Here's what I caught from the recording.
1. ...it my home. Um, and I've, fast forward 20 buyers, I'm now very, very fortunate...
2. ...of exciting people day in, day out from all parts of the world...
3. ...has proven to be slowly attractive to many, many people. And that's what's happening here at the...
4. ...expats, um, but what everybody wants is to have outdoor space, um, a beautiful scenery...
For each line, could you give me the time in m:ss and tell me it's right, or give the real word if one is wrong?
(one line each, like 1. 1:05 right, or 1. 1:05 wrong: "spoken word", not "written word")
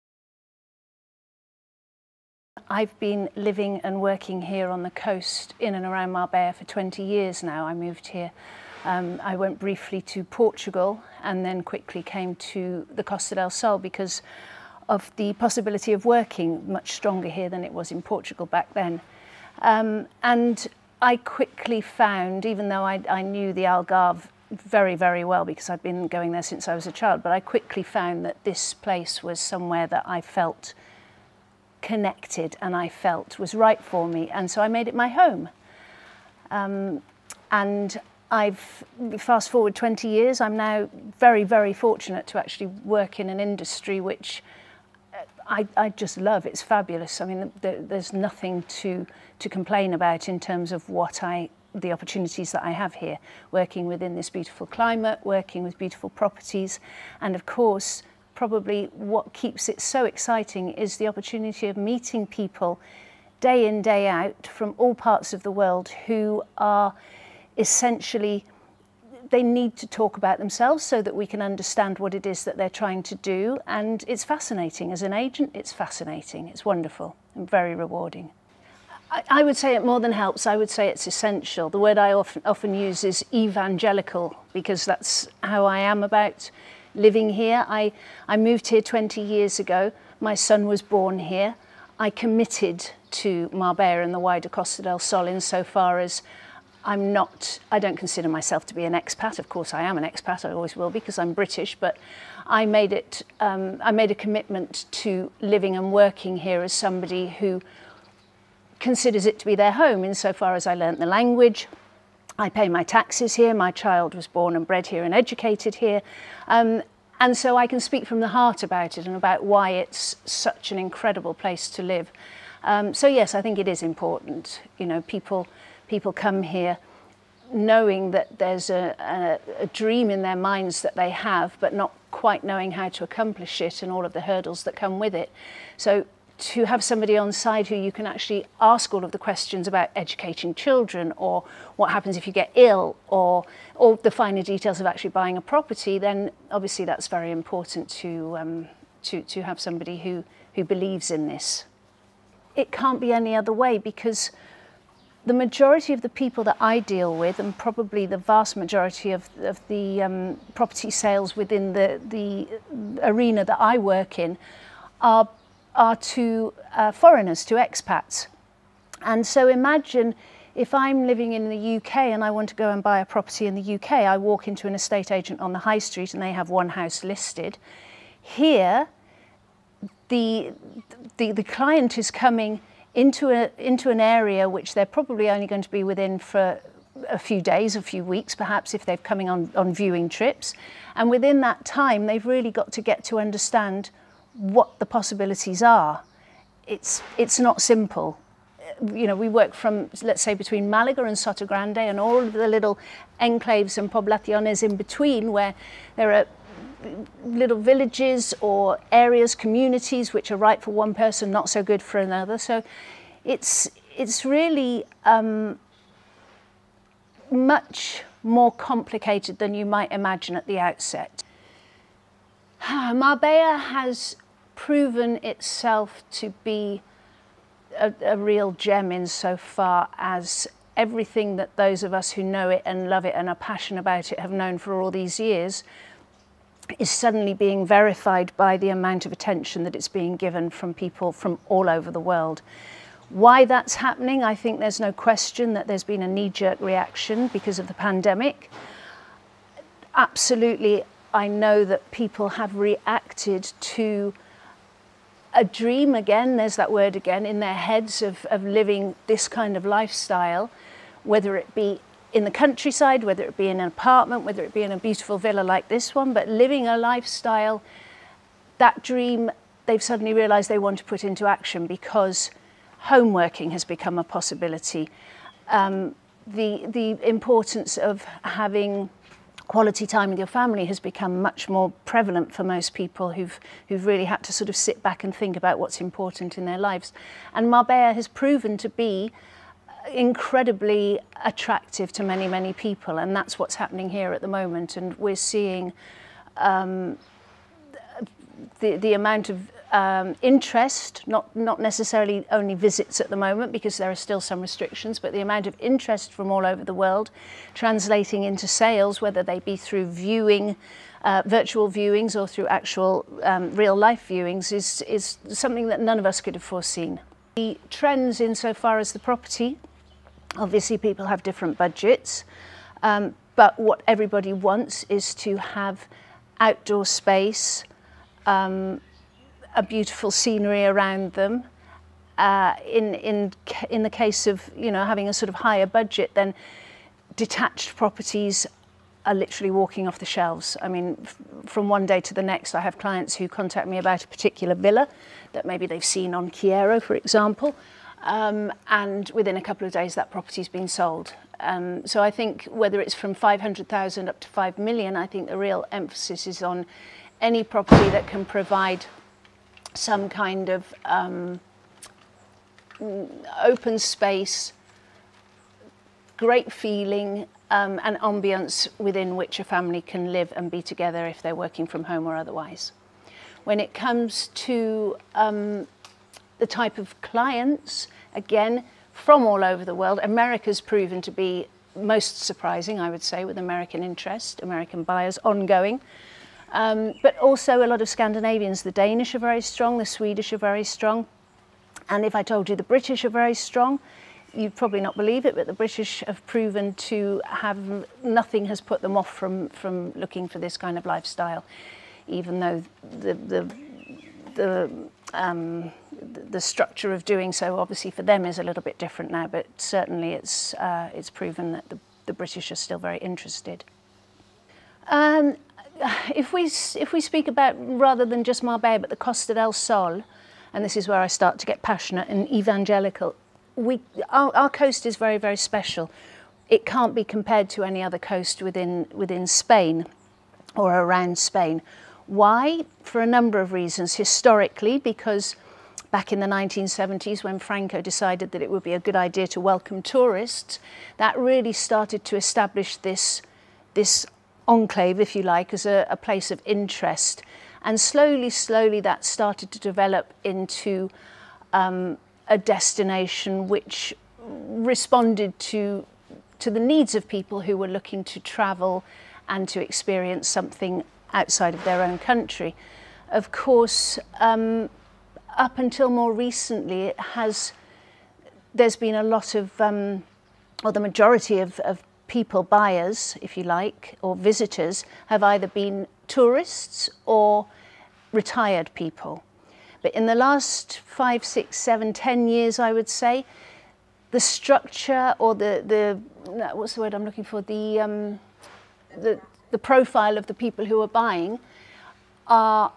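1. 0:34 wrong: "years", not "buyers"
2. 1:01 wrong: "meeting", not "exciting"
3. 4:47 wrong: "incredibly", not "slowly"
4. 5:21 wrong: "budgets", not "expats".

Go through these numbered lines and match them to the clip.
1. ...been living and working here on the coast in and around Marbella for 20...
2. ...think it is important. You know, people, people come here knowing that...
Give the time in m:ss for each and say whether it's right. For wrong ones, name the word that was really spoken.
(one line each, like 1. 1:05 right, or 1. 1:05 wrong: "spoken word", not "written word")
1. 0:02 right
2. 2:03 right.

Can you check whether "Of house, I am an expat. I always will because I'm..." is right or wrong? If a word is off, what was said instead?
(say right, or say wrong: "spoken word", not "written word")
wrong: "course", not "house".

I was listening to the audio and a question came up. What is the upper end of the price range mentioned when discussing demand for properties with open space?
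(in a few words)
5 million.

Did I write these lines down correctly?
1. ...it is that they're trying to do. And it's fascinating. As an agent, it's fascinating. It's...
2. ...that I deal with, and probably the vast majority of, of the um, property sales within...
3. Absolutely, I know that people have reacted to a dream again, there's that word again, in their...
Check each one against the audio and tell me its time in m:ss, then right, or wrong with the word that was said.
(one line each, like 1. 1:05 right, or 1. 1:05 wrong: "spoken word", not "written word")
1. 1:12 right
2. 2:36 right
3. 4:09 right.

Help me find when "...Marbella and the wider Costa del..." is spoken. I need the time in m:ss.
1:33.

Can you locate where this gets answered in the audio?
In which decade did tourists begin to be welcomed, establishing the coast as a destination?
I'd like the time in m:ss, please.
7:16.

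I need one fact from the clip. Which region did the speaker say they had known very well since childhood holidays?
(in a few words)
The Algarve.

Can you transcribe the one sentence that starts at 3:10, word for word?
And within that time, they've really got to get to understand what the possibilities are, it's, it's not simple.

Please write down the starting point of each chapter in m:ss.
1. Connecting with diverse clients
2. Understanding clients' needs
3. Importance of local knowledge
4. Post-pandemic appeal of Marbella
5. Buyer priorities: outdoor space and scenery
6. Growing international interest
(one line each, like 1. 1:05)
1. 0:15
2. 1:11
3. 2:04
4. 3:41
5. 5:51
6. 6:20.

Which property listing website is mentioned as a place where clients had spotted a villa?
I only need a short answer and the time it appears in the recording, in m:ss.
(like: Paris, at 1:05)
Kyero, at 5:46.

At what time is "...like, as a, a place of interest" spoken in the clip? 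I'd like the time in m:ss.
7:25.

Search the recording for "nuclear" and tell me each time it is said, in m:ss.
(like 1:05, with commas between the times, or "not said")
not said.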